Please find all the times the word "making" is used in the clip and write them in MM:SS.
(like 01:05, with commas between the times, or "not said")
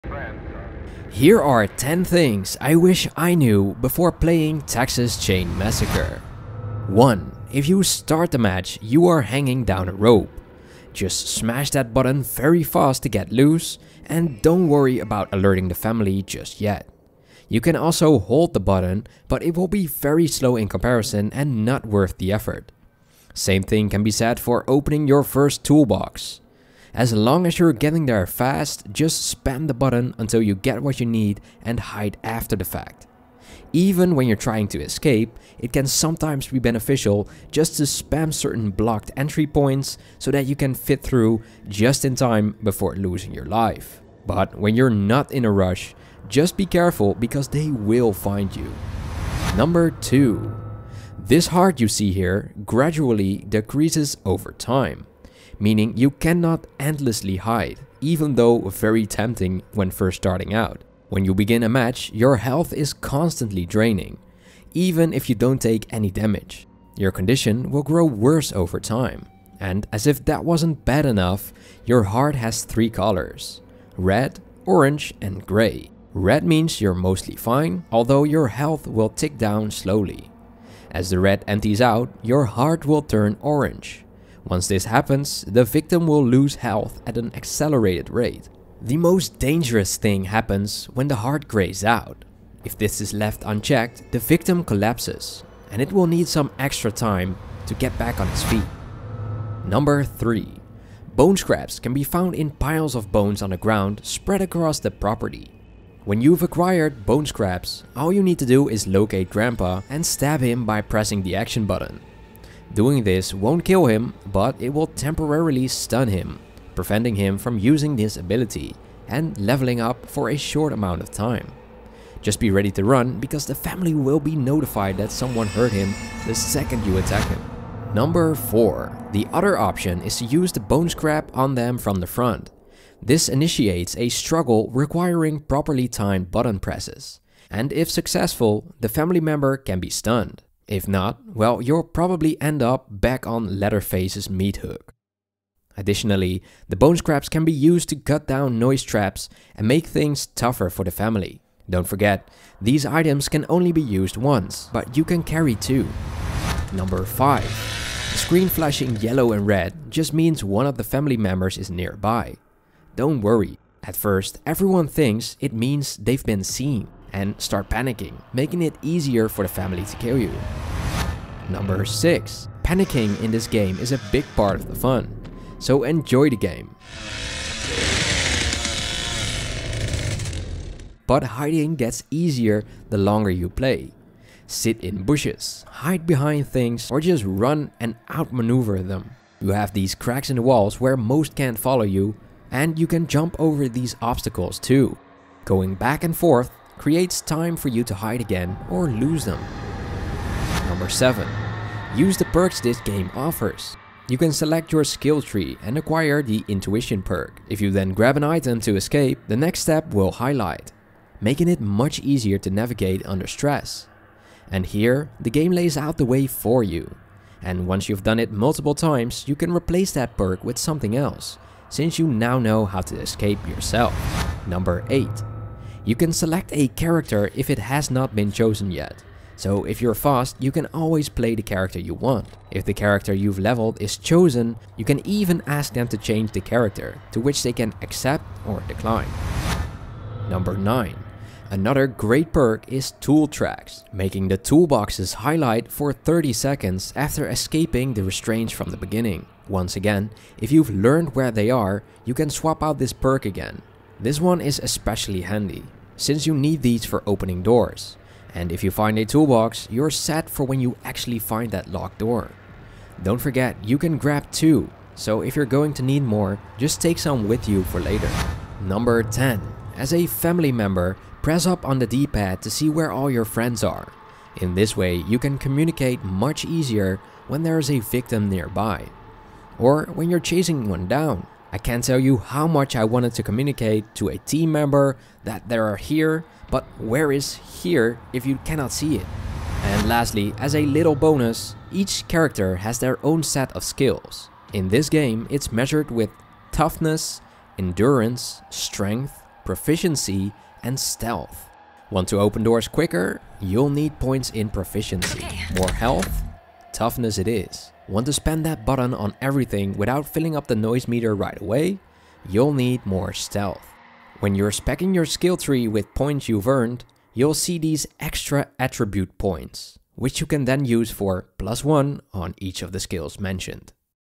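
02:48, 03:31, 04:03.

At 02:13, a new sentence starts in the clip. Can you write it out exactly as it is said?
This initiates a struggle requiring properly timed button presses.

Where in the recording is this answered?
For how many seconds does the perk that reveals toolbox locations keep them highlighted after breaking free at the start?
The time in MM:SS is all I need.
04:05.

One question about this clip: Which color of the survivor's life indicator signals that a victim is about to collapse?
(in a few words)
Grey.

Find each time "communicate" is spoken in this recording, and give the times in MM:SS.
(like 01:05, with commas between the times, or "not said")
04:35, 04:43.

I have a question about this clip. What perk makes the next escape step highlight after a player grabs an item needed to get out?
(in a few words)
Intuition.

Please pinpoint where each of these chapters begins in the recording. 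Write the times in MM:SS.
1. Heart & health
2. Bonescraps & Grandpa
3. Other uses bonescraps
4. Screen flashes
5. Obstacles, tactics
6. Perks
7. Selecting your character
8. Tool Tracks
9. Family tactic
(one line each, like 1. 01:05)
1. 00:50
2. 01:39
3. 02:07
4. 02:37
5. 02:51
6. 03:23
7. 03:45
8. 04:00
9. 04:28.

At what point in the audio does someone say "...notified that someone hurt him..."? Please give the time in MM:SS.
02:04.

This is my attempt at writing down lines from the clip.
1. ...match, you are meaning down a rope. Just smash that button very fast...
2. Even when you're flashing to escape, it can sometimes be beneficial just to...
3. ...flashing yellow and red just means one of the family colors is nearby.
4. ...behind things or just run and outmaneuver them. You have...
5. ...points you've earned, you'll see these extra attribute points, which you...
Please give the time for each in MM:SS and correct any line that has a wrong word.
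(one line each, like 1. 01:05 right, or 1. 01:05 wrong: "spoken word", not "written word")
1. 00:08 wrong: "hanging", not "meaning"
2. 00:33 wrong: "trying", not "flashing"
3. 02:38 wrong: "members", not "colors"
4. 03:06 right
5. 05:15 right.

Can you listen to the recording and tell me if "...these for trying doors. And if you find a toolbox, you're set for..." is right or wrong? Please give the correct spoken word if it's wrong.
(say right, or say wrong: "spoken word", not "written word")
wrong: "opening", not "trying".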